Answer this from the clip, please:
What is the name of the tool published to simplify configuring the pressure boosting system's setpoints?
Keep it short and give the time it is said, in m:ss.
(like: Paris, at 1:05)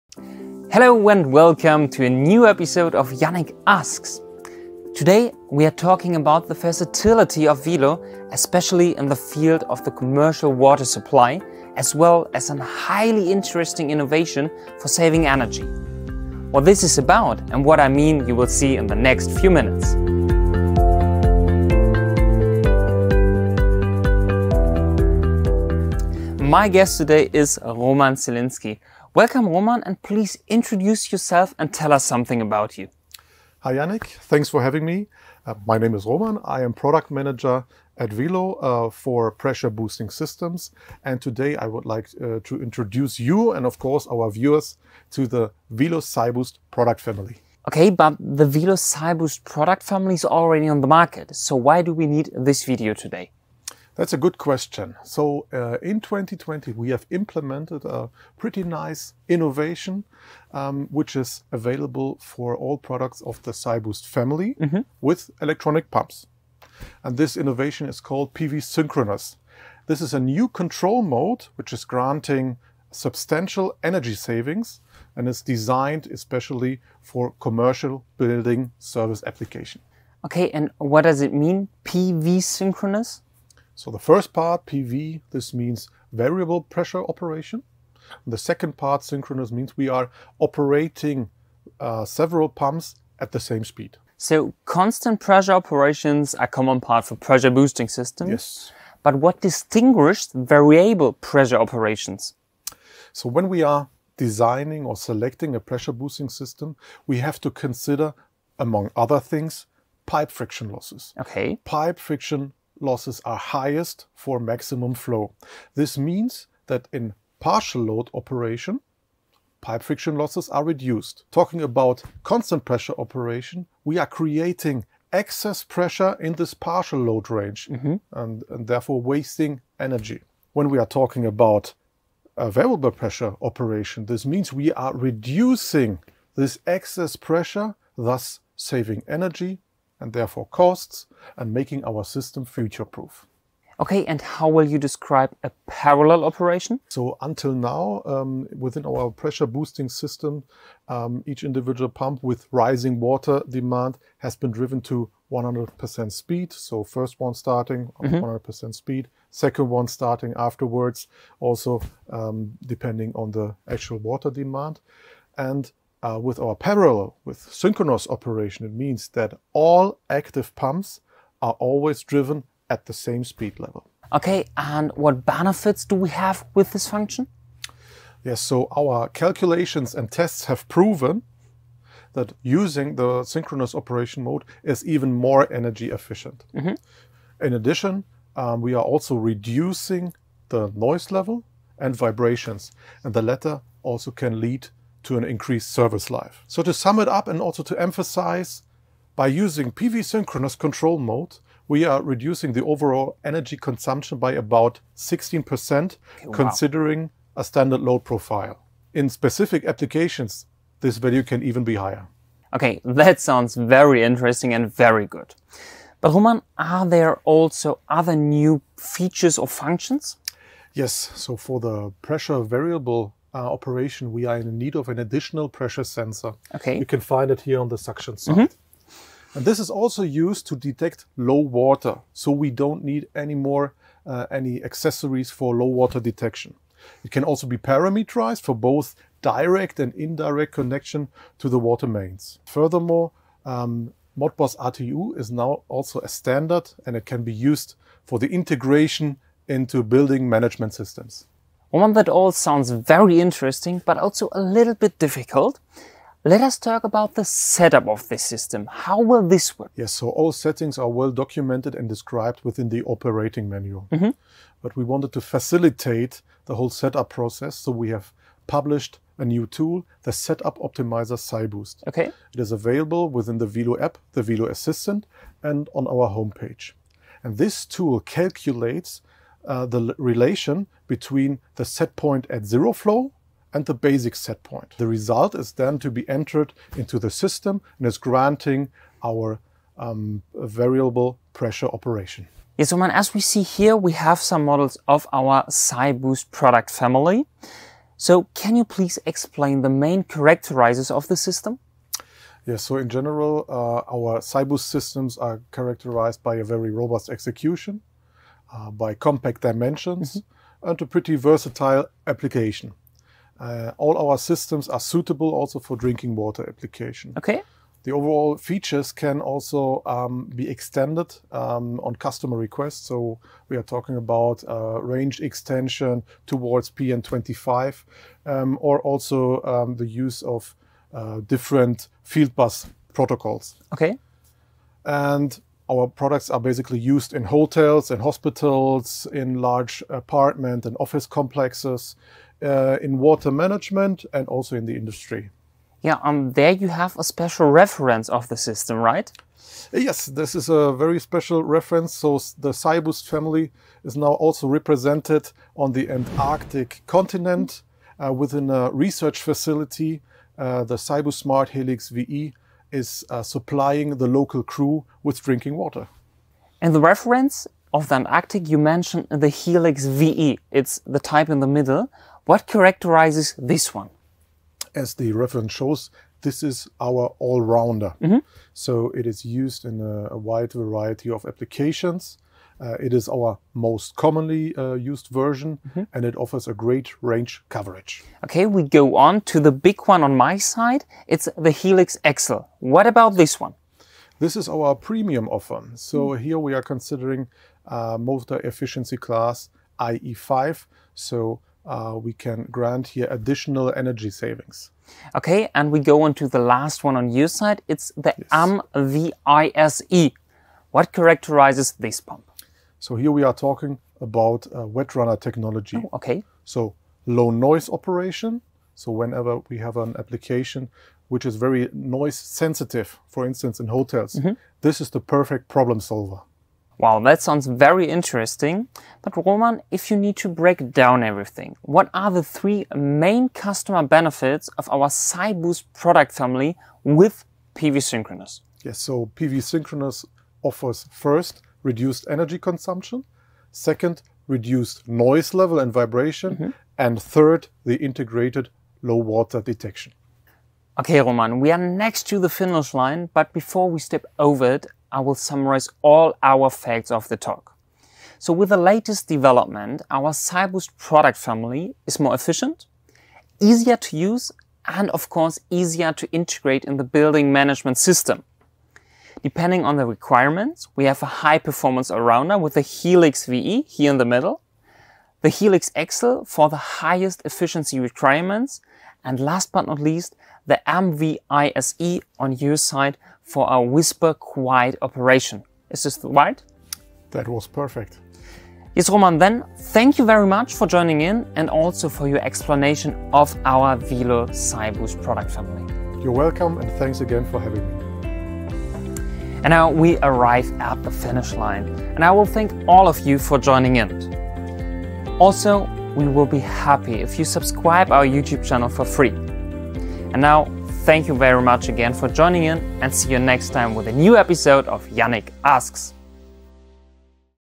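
Setup Optimizer SiBoost, at 4:30.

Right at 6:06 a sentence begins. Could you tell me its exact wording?
And the reference of the Antarctic, you mentioned the Helix VE.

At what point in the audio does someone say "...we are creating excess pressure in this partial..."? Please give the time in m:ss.
2:03.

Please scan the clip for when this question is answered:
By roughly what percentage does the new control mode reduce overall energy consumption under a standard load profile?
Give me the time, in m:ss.
3:24.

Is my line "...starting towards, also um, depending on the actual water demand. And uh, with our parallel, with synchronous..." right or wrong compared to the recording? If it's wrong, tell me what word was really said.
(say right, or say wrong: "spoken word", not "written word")
wrong: "afterwards", not "towards".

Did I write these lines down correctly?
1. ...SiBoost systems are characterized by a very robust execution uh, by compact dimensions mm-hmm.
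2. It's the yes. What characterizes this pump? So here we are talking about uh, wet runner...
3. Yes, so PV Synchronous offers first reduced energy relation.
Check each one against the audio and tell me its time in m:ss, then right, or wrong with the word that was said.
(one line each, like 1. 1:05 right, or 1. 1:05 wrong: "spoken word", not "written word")
1. 5:04 right
2. 6:47 right
3. 7:18 wrong: "consumption", not "relation".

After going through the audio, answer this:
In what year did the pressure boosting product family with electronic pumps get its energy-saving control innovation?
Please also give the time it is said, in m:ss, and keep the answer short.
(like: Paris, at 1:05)
2020, at 0:56.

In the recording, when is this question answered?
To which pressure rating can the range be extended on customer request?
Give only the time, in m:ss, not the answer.
5:26.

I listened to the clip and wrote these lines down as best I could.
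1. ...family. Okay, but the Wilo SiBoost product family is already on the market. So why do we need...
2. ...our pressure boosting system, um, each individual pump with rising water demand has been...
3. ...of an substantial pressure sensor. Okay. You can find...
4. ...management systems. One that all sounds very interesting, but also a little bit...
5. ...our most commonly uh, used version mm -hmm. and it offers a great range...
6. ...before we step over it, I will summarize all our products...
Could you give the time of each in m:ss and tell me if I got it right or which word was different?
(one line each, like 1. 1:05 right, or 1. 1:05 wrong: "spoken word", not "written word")
1. 0:47 right
2. 2:28 right
3. 3:44 wrong: "additional", not "substantial"
4. 4:10 right
5. 6:23 right
6. 7:33 wrong: "facts", not "products".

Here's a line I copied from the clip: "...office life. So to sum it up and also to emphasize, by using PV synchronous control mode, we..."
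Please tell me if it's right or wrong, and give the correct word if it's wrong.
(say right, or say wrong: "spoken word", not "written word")
wrong: "service", not "office".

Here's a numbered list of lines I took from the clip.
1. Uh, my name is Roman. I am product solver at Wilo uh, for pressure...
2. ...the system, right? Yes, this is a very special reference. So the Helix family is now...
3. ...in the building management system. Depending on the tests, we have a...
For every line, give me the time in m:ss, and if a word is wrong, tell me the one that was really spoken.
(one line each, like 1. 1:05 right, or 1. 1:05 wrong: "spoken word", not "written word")
1. 0:35 wrong: "manager", not "solver"
2. 5:48 wrong: "SiBoost", not "Helix"
3. 7:46 wrong: "requirements", not "tests".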